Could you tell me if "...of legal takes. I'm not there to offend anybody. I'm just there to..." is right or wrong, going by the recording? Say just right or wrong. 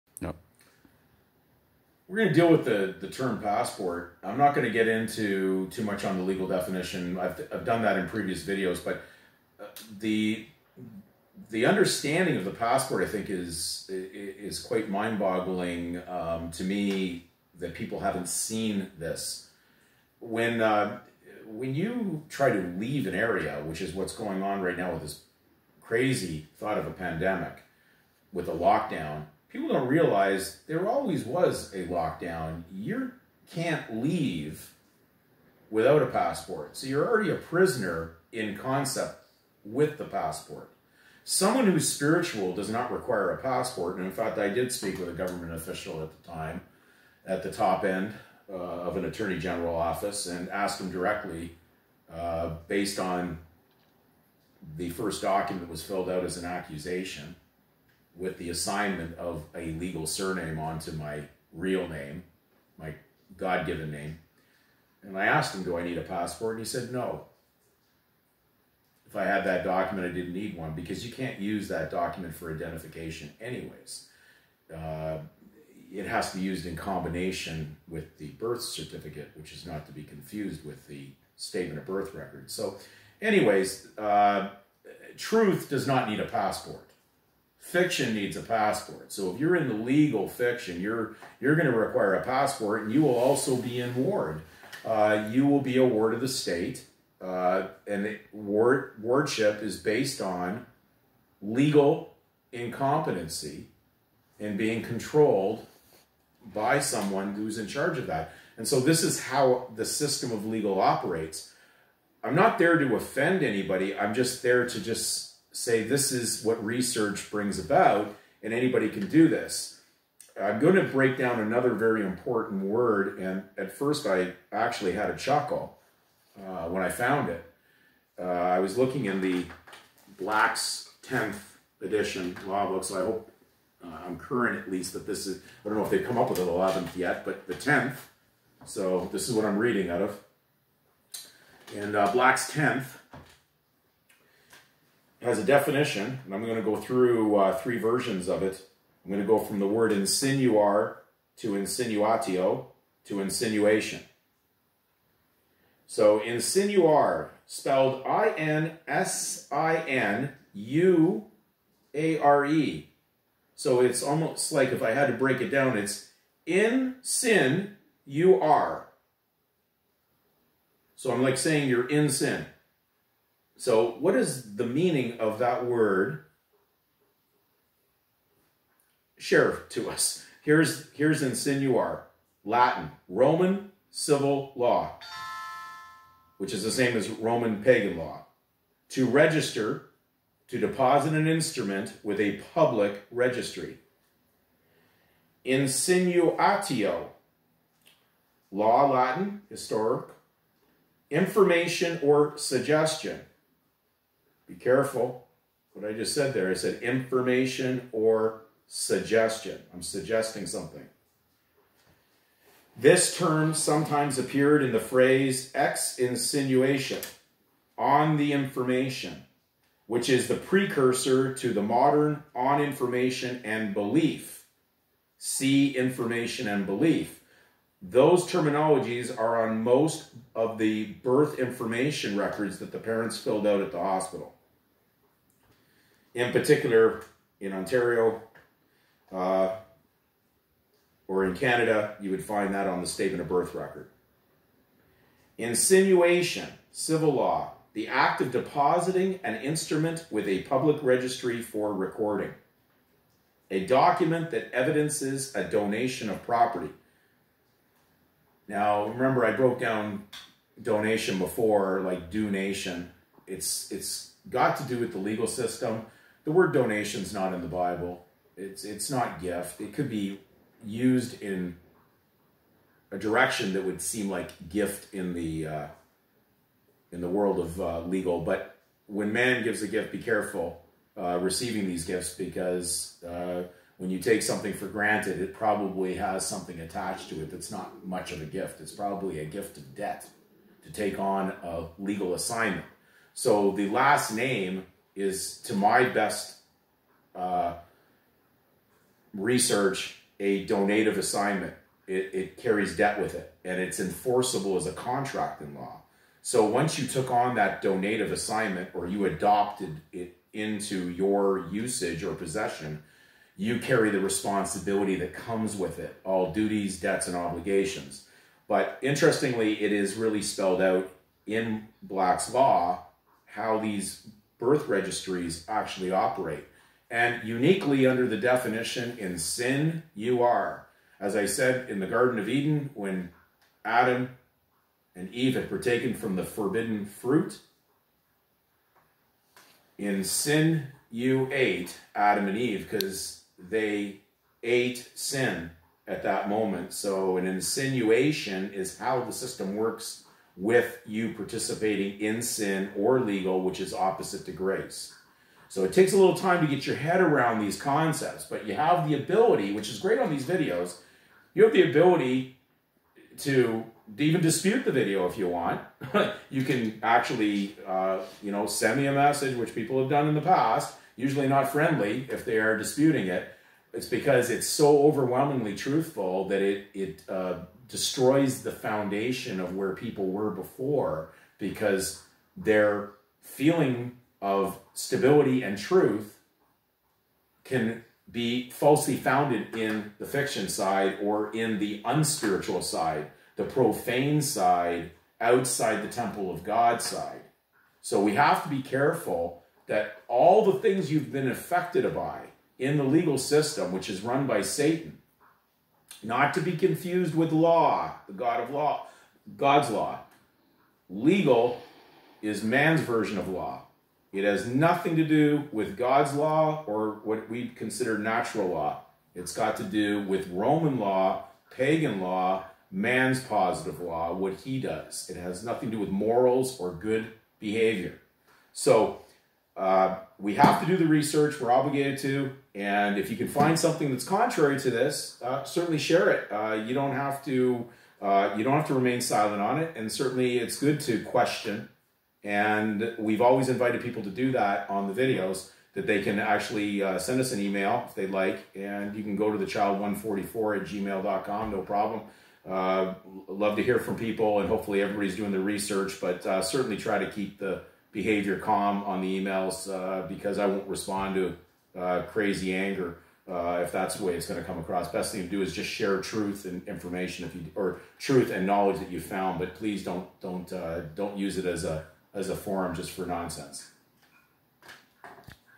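wrong.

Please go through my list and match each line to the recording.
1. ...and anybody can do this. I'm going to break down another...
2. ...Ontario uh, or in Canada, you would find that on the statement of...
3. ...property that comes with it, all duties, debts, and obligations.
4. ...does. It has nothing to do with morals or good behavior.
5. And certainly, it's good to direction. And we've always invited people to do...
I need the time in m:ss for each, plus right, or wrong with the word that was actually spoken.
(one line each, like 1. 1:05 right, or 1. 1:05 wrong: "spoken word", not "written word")
1. 1:58 right
2. 3:57 right
3. 5:13 wrong: "responsibility", not "property"
4. 7:04 right
5. 7:19 wrong: "question", not "direction".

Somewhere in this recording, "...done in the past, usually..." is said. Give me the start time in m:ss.
6:09.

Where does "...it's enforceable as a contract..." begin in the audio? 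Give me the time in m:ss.
5:03.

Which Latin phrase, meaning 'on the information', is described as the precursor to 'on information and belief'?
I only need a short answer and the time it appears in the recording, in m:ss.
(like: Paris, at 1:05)
Ex insinuation, at 3:35.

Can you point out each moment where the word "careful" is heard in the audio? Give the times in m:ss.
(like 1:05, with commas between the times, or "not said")
3:24, 4:40, 6:38.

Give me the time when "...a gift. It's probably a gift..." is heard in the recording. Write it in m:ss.
4:48.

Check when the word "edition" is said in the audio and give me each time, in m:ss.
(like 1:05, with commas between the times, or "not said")
2:11.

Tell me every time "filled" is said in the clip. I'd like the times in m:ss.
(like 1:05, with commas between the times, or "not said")
0:55, 3:53.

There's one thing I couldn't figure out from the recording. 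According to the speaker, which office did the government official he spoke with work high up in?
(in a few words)
Attorney general office.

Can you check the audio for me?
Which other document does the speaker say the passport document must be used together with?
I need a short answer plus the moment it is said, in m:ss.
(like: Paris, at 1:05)
Birth certificate, at 1:18.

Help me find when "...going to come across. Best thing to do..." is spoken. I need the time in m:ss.
7:44.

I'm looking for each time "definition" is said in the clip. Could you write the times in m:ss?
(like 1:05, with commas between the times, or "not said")
0:06, 2:25, 5:28.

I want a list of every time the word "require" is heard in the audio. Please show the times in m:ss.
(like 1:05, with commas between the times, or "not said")
0:42, 1:31.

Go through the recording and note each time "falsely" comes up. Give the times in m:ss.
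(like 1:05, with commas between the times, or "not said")
6:28.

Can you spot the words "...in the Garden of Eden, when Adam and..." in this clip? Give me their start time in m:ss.
5:31.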